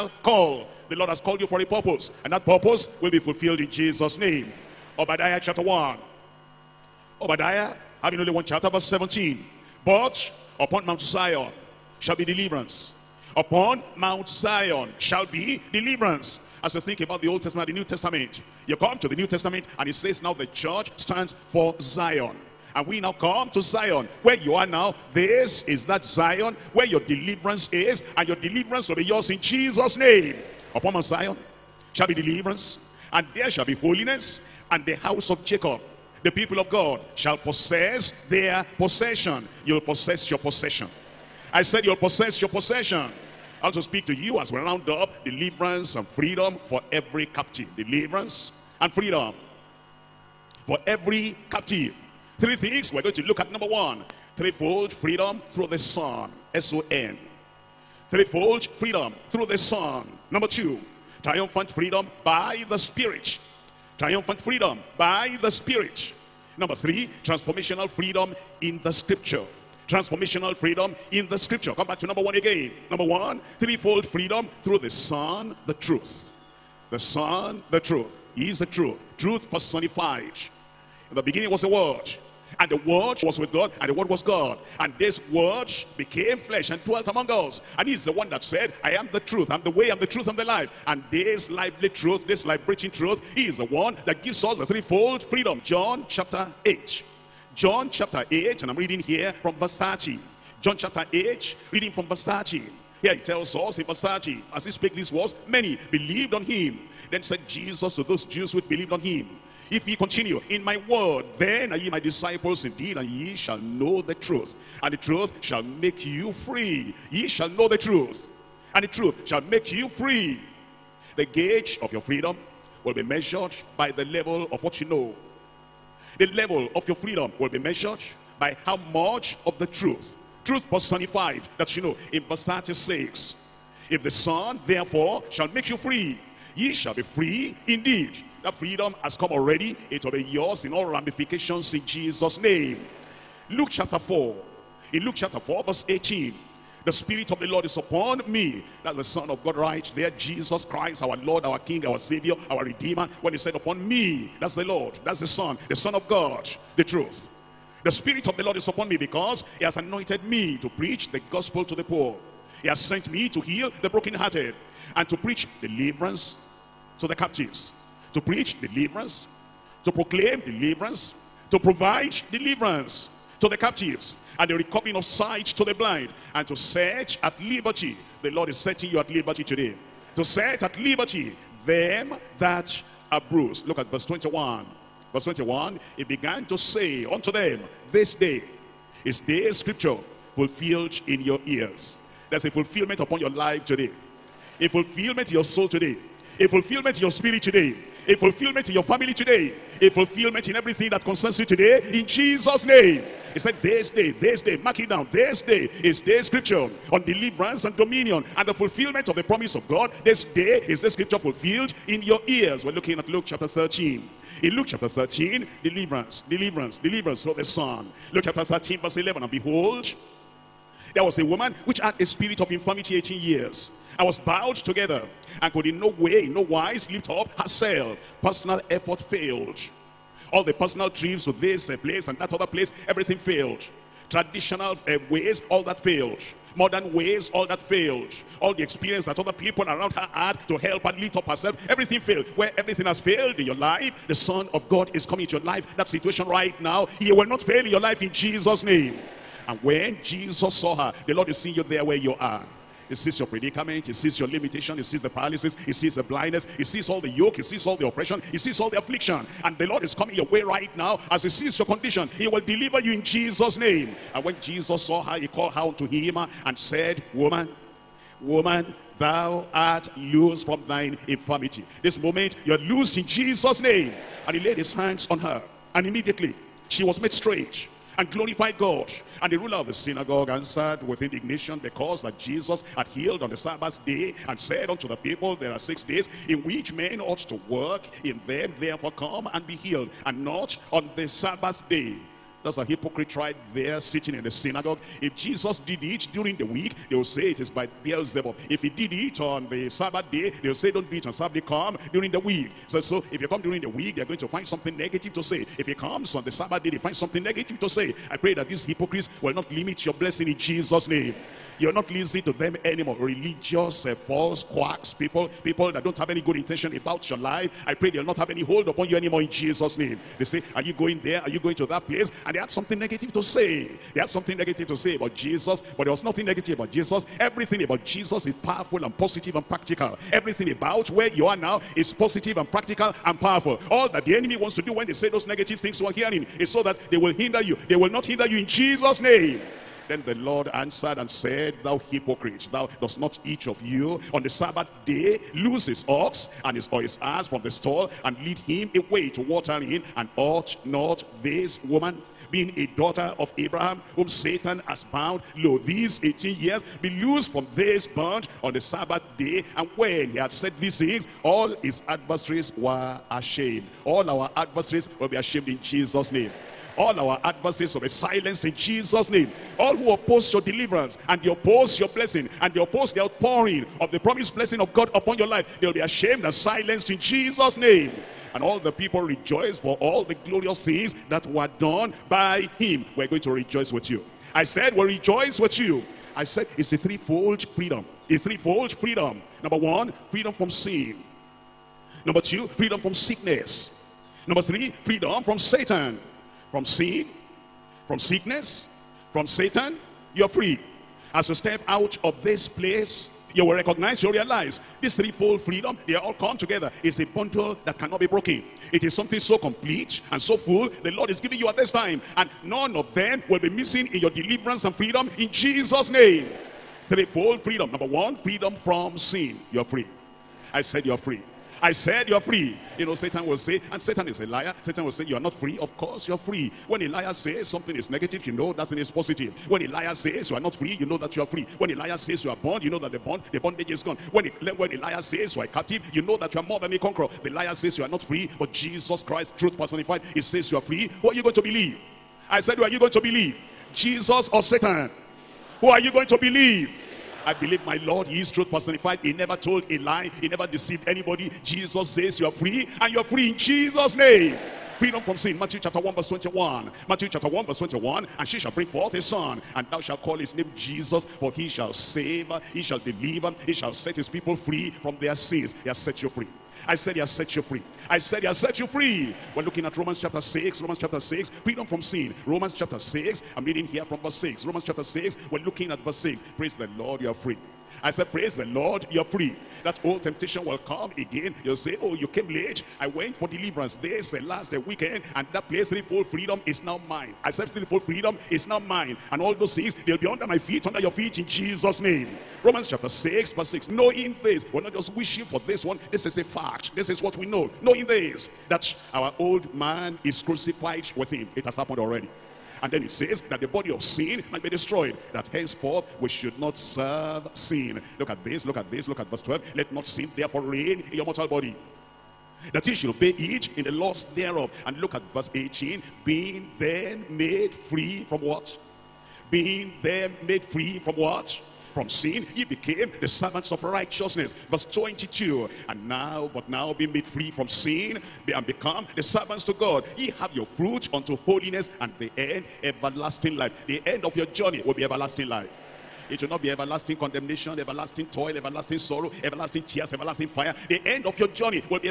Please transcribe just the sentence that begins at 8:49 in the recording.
Ye have your fruit unto holiness and the end everlasting life.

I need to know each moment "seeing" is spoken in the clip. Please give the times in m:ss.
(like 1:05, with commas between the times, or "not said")
4:11.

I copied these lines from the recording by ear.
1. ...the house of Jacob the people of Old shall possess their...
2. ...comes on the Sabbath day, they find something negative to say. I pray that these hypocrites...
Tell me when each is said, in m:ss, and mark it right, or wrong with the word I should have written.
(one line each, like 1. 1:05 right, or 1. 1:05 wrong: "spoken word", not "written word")
1. 0:34 wrong: "God", not "Old"
2. 5:05 right.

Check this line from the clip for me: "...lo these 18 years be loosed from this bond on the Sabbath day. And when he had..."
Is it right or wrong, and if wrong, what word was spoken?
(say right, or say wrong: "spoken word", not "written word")
right.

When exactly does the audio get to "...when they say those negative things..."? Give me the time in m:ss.
5:34.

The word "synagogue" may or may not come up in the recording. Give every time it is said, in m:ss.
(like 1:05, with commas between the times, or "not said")
4:39, 4:54.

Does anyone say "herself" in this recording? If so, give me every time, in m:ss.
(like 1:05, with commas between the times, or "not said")
3:47, 4:01.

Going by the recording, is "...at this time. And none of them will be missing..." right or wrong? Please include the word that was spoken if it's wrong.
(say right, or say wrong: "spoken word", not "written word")
right.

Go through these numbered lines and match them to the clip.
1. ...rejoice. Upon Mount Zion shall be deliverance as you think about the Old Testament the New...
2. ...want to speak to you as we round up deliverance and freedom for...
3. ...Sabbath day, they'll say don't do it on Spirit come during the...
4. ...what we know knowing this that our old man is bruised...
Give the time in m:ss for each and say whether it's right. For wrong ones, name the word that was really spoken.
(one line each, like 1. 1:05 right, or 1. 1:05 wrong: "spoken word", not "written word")
1. 0:12 wrong: "deliverance", not "rejoice"
2. 0:43 right
3. 4:59 wrong: "Sabbath", not "Spirit"
4. 8:16 wrong: "crucified", not "bruised".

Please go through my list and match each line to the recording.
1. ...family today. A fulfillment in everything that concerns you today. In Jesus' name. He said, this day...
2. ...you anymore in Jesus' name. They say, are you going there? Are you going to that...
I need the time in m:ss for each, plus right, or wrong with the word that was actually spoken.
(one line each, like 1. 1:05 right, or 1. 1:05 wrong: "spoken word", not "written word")
1. 3:18 right
2. 5:18 right.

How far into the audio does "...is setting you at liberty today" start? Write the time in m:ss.
2:58.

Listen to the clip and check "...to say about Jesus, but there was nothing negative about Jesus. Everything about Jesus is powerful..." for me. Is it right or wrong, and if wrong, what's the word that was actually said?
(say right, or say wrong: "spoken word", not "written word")
right.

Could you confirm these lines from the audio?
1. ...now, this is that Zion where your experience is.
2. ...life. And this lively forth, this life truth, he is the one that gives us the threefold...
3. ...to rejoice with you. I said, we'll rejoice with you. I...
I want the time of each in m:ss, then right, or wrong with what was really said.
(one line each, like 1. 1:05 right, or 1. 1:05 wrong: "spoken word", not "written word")
1. 0:24 wrong: "deliverance", not "experience"
2. 1:30 wrong: "truth", not "forth"
3. 6:23 right.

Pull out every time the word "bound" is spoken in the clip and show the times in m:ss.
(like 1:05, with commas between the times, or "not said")
5:54, 7:12.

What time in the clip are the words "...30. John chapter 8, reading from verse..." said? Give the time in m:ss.
1:39.